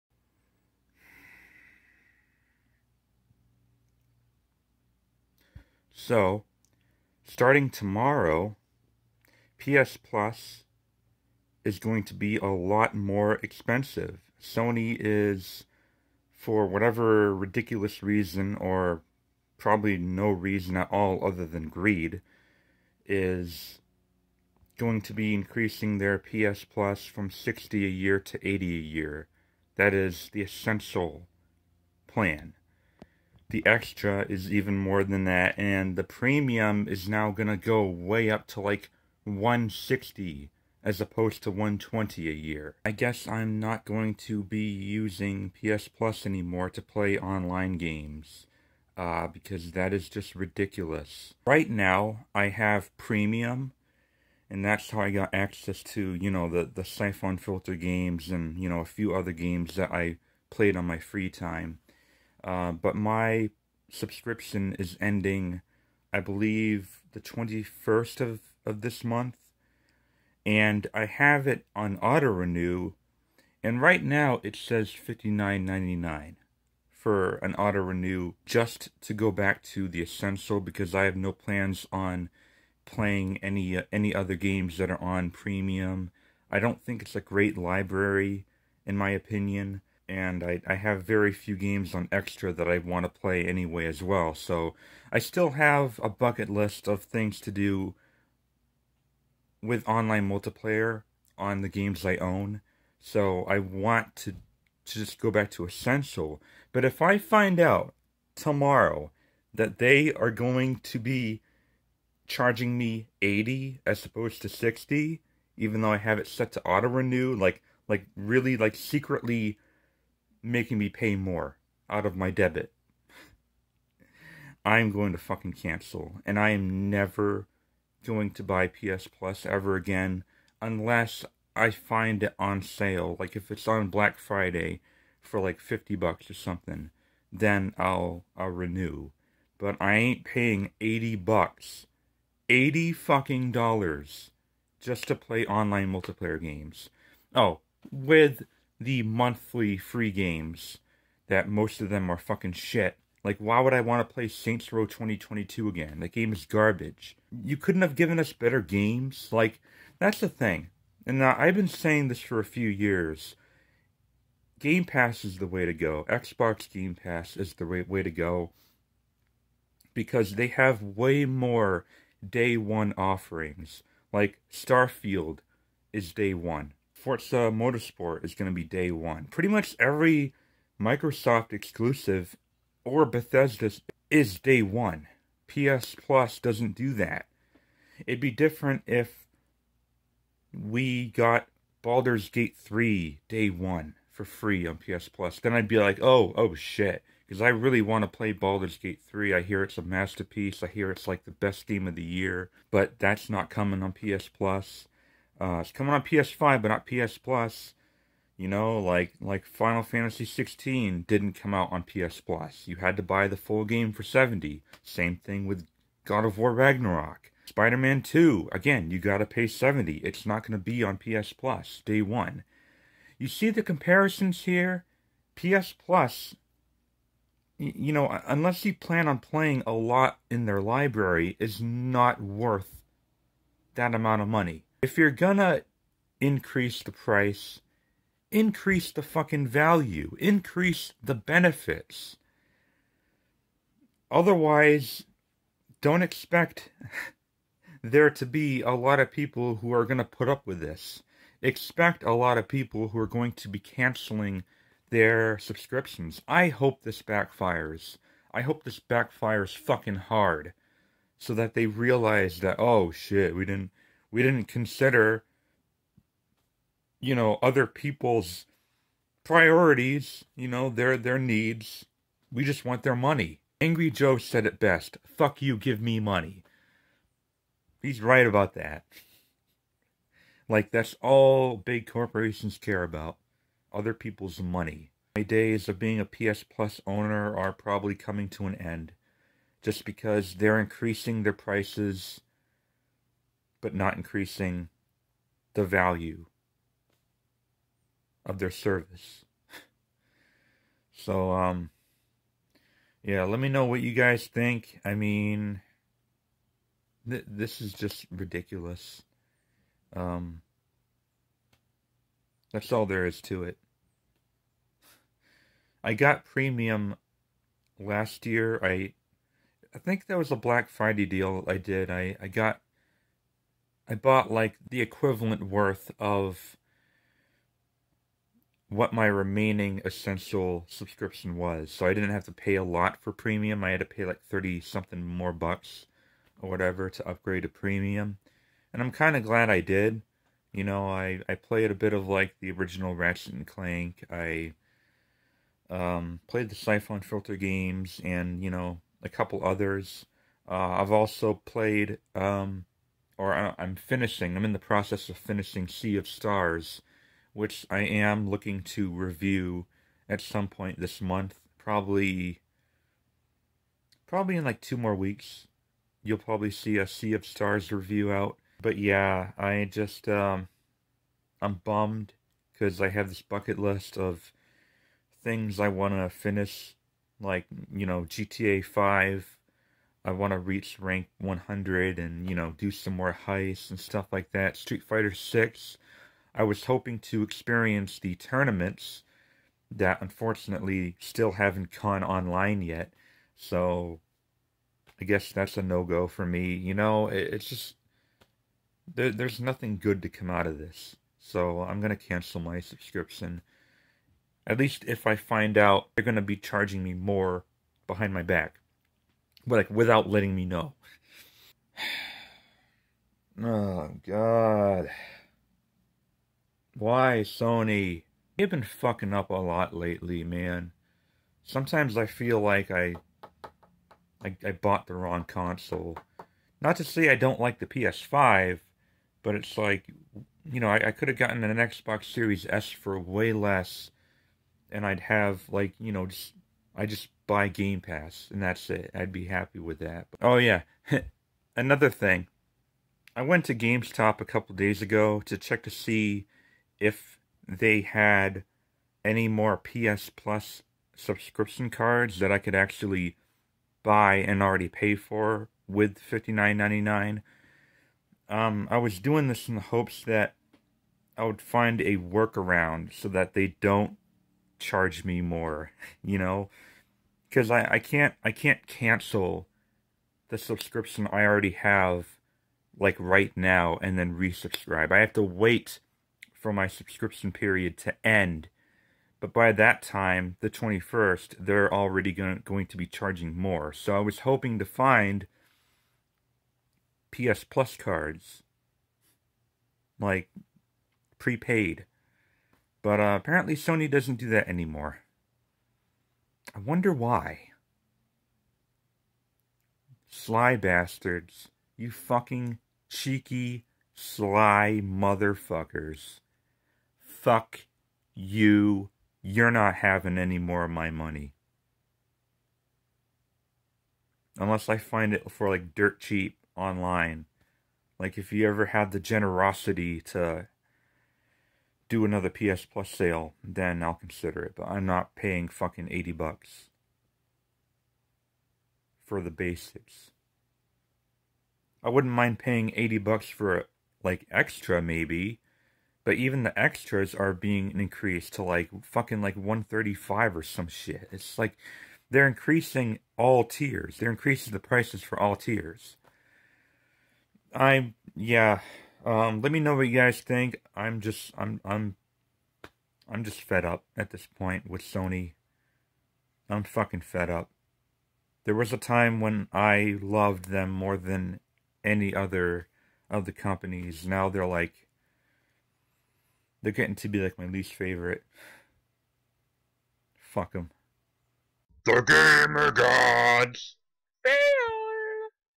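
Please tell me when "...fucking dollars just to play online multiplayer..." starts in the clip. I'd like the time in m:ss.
2:22.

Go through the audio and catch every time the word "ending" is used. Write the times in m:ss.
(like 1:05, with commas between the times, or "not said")
1:04.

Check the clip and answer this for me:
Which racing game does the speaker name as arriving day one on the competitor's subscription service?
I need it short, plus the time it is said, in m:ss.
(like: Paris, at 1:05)
Forza Motorsport, at 2:57.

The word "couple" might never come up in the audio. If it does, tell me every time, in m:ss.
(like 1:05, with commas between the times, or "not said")
5:49, 7:24.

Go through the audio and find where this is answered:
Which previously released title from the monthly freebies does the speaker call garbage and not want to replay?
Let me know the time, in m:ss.
2:34.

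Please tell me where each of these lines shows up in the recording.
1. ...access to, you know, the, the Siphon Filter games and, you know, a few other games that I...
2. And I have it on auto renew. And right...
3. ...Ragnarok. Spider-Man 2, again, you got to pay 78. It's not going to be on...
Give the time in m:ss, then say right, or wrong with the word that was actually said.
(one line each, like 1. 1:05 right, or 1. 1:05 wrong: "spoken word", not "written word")
1. 0:55 right
2. 1:10 right
3. 3:36 wrong: "70", not "78".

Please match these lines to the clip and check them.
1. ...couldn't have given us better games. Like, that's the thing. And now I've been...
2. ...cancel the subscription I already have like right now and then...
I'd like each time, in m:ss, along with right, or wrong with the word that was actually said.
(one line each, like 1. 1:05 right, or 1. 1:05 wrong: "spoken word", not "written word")
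1. 2:37 right
2. 7:48 right.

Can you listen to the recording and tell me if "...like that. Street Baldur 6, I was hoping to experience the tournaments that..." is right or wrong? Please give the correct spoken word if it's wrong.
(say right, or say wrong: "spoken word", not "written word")
wrong: "Fighter", not "Baldur".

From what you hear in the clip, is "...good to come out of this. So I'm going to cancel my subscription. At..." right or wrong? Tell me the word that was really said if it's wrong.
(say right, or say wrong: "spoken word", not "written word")
right.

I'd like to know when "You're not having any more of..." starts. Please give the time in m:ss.
8:29.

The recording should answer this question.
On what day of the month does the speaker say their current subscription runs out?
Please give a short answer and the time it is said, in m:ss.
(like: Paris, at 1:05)
21st, at 1:07.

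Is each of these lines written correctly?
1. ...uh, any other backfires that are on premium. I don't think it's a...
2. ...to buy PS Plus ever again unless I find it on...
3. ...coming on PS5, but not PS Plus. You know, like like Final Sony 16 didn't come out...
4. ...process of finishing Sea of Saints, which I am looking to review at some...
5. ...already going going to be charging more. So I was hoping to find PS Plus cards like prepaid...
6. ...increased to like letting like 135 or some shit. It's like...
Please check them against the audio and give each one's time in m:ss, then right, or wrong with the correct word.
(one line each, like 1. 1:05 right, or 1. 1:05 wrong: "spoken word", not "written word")
1. 1:23 wrong: "games", not "backfires"
2. 2:08 right
3. 3:25 wrong: "Fantasy", not "Sony"
4. 5:54 wrong: "Stars", not "Saints"
5. 8:01 right
6. 8:57 wrong: "fucking", not "letting".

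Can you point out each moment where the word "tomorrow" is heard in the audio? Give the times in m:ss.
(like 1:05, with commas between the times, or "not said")
0:07, 1:48.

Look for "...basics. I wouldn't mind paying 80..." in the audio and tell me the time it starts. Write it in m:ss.
8:49.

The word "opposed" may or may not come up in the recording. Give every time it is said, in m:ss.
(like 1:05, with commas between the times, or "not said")
0:41, 1:54.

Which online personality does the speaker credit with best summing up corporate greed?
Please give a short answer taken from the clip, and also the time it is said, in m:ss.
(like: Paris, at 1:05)
Angry Joe, at 4:33.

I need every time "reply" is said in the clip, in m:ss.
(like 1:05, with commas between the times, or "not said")
not said.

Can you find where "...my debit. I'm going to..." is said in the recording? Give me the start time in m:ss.
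2:02.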